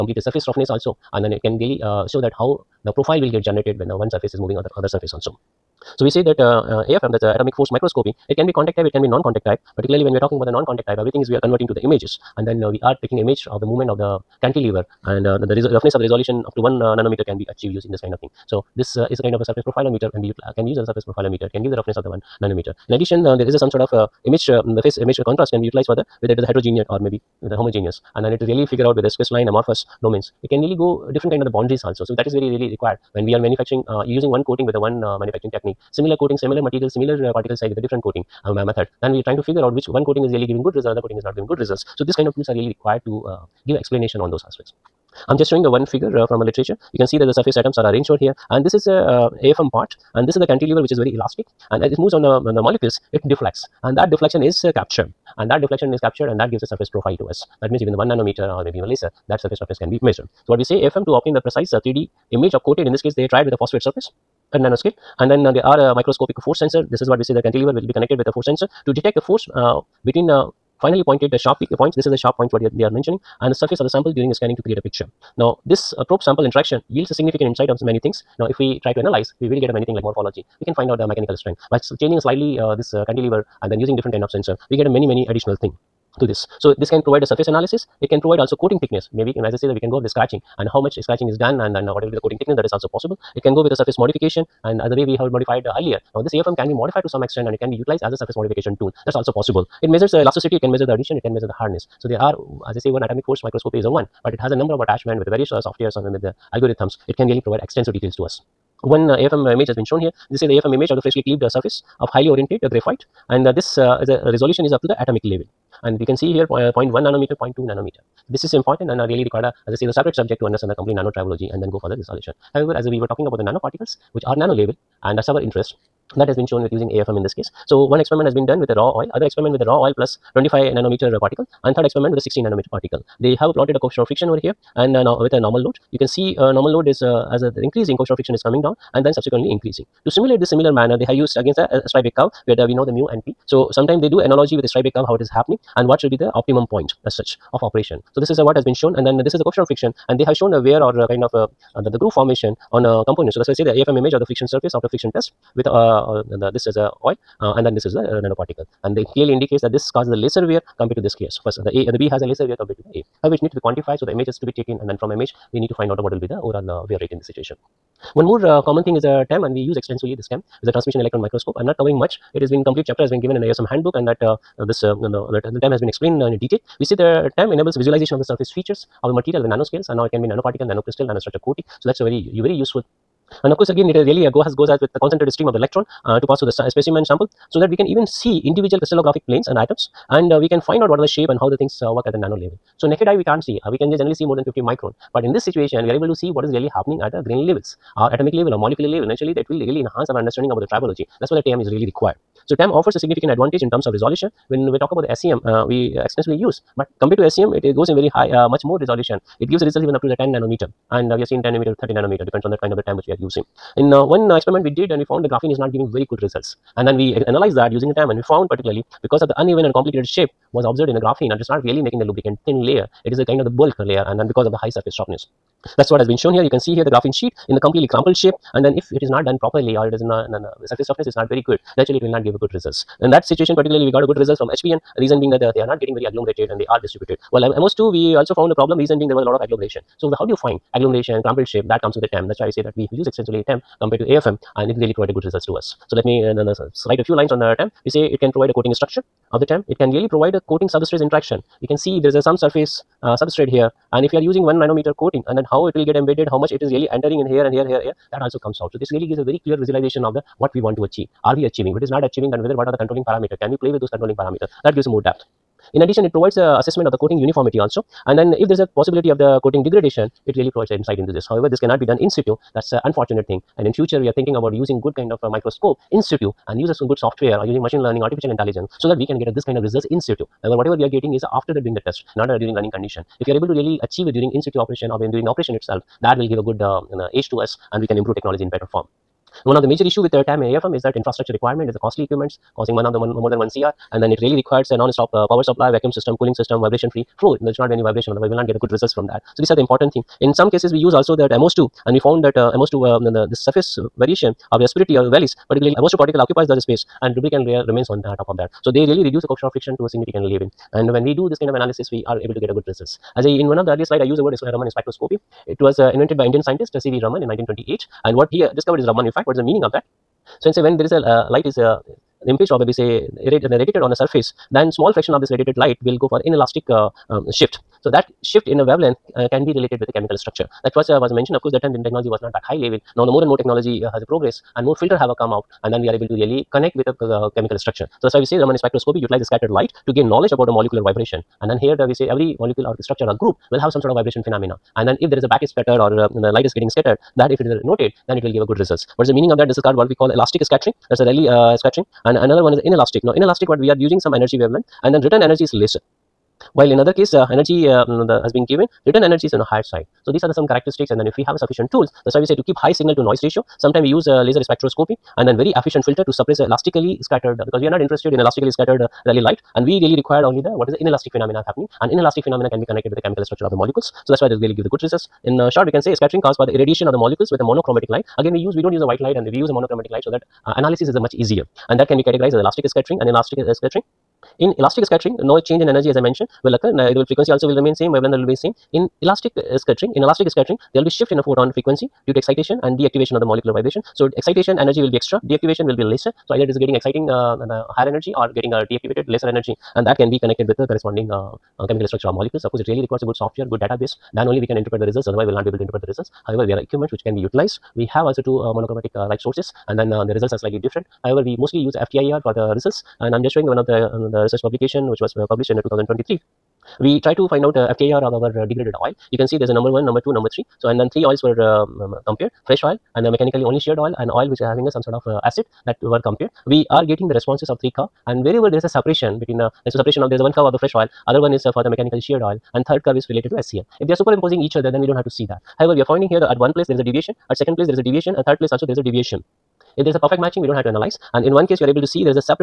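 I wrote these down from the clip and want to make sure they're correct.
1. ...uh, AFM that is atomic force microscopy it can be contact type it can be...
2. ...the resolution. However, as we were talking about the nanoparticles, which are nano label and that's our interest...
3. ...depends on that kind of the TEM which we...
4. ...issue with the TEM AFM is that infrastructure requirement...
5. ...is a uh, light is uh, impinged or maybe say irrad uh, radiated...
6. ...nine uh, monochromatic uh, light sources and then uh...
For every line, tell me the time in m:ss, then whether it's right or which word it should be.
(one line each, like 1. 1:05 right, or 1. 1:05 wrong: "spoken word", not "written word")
1. 0:06 right
2. 2:01 right
3. 3:32 right
4. 4:49 right
5. 5:20 right
6. 6:48 wrong: "two", not "nine".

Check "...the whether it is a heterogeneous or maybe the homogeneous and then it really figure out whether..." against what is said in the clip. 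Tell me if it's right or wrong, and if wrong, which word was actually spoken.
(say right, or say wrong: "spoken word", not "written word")
right.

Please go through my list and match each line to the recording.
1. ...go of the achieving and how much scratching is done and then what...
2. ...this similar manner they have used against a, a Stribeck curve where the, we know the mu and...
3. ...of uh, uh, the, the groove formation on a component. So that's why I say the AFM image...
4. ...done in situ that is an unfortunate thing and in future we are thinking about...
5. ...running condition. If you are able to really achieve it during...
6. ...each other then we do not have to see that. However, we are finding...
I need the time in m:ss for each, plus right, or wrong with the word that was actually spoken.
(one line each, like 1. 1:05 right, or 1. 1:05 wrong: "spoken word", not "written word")
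1. 1:29 wrong: "scratching", not "achieving"
2. 2:20 right
3. 2:31 right
4. 4:31 right
5. 4:42 right
6. 7:14 right.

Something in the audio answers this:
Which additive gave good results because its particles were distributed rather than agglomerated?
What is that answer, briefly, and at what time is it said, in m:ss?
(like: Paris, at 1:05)
hBN, at 3:54.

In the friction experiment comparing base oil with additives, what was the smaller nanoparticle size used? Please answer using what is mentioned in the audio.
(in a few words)
25 nanometer.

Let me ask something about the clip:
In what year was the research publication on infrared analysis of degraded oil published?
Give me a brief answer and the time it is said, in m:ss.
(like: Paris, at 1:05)
2023, at 6:55.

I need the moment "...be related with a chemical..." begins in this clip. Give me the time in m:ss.
5:29.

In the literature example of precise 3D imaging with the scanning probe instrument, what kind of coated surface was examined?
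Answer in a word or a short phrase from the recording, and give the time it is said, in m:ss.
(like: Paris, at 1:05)
phosphate surface, at 1:03.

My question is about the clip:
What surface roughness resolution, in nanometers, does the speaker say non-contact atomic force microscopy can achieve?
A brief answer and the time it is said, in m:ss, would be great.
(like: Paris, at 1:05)
1 nanometer, at 0:16.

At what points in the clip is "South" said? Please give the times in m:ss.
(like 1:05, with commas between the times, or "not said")
not said.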